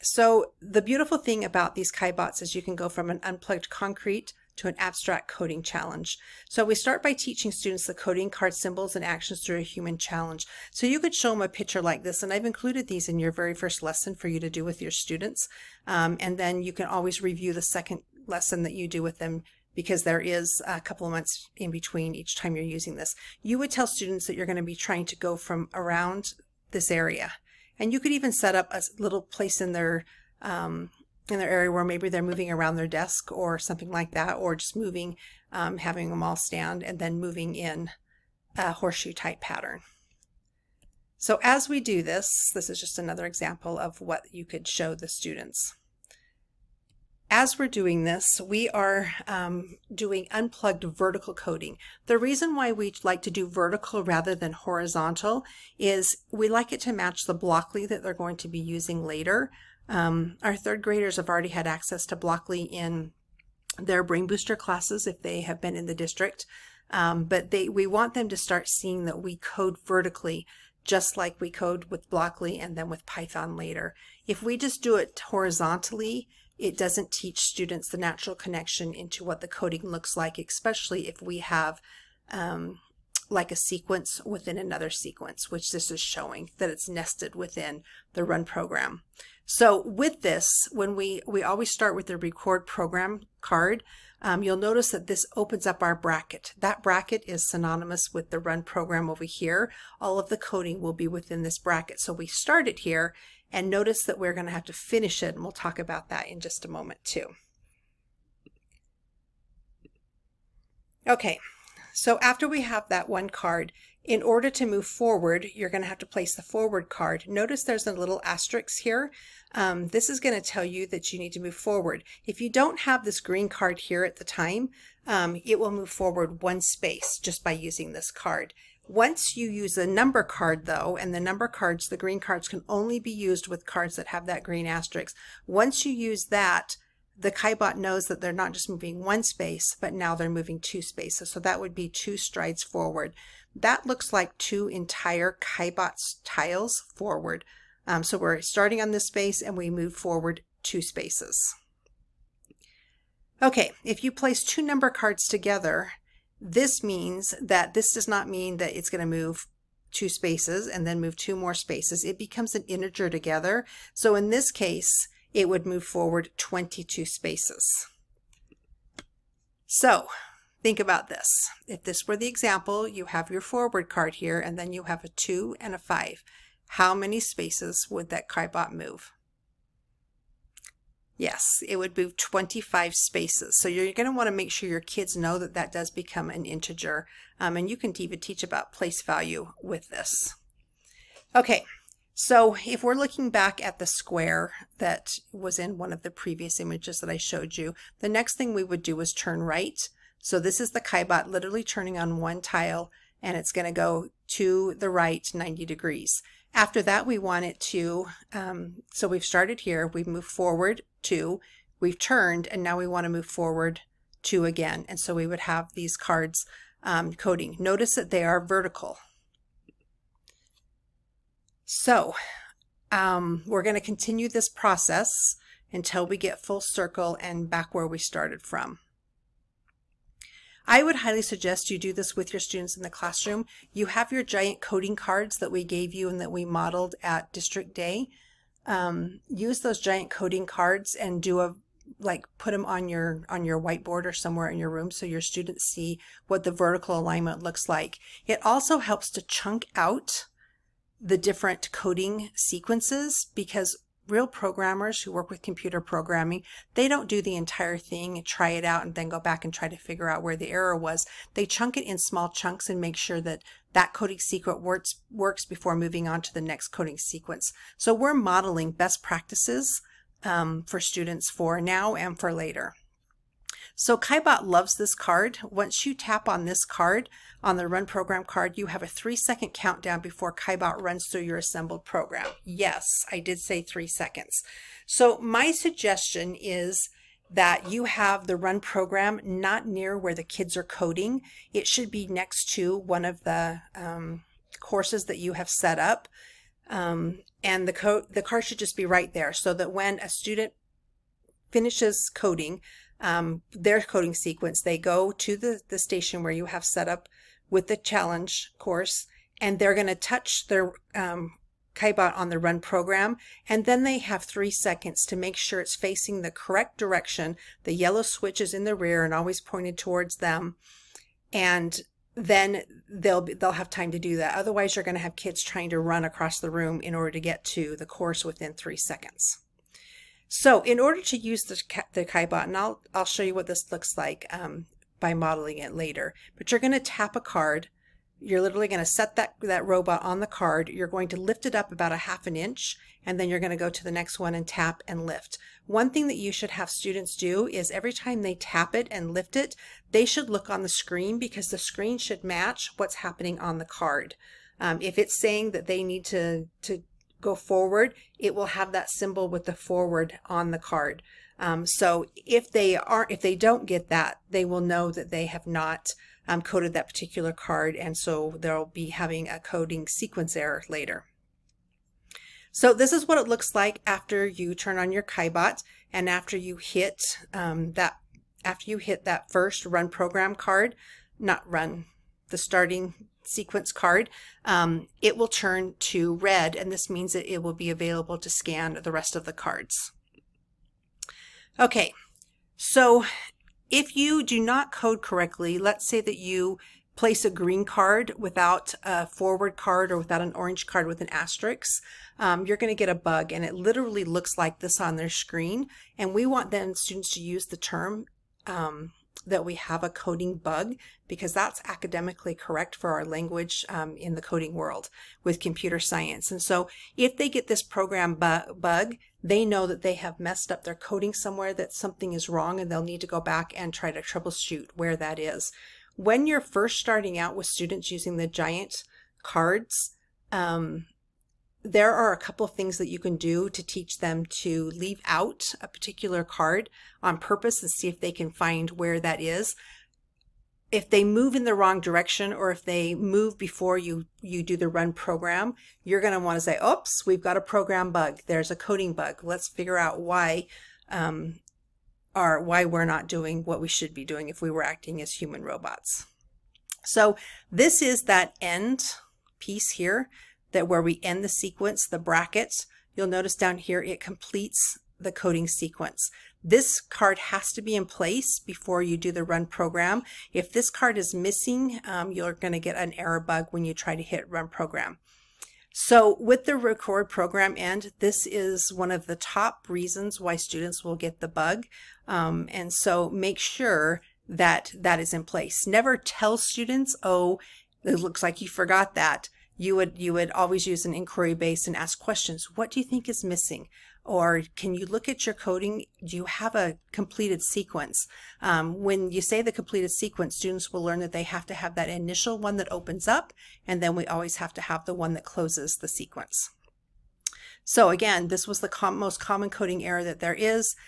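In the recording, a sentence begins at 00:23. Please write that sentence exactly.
You would tell students that you're going to be trying to go from around this area.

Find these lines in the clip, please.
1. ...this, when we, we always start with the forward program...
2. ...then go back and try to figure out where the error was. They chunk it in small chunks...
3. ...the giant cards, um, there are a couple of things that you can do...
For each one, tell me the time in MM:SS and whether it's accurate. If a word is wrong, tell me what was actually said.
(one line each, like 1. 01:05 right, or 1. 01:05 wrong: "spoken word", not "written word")
1. 01:30 wrong: "record", not "forward"
2. 04:18 right
3. 07:08 right.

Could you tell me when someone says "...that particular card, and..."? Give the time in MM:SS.
06:06.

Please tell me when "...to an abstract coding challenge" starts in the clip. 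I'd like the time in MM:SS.
00:04.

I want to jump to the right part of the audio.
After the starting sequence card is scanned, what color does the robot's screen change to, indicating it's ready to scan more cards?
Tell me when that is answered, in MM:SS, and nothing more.
06:26.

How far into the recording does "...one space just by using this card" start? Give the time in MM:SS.
02:06.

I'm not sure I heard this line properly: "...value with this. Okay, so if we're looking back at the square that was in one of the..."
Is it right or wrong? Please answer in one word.
right.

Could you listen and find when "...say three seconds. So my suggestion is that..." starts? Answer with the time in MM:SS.
04:43.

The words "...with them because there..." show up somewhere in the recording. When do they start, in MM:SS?
00:19.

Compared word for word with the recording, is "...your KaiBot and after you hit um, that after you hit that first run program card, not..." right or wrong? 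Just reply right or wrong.
right.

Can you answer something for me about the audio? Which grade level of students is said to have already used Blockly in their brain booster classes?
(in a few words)
Third graders.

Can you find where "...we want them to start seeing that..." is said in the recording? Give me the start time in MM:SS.
01:07.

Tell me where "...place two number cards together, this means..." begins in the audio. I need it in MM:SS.
02:34.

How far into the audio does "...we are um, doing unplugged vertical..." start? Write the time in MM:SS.
00:48.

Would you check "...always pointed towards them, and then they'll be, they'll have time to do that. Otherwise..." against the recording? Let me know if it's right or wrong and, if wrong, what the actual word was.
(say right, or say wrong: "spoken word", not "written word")
right.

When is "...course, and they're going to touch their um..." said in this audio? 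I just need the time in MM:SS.
05:08.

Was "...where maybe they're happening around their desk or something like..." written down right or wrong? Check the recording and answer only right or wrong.
wrong.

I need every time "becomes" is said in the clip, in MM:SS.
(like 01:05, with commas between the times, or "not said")
02:42, 03:05.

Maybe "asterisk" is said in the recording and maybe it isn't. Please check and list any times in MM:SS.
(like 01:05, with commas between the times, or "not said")
01:58, 02:14, 06:41.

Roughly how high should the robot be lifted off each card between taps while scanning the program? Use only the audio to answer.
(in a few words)
Half an inch.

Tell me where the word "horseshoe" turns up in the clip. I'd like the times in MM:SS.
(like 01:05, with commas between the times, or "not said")
00:38.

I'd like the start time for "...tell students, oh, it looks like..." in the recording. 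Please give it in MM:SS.
08:05.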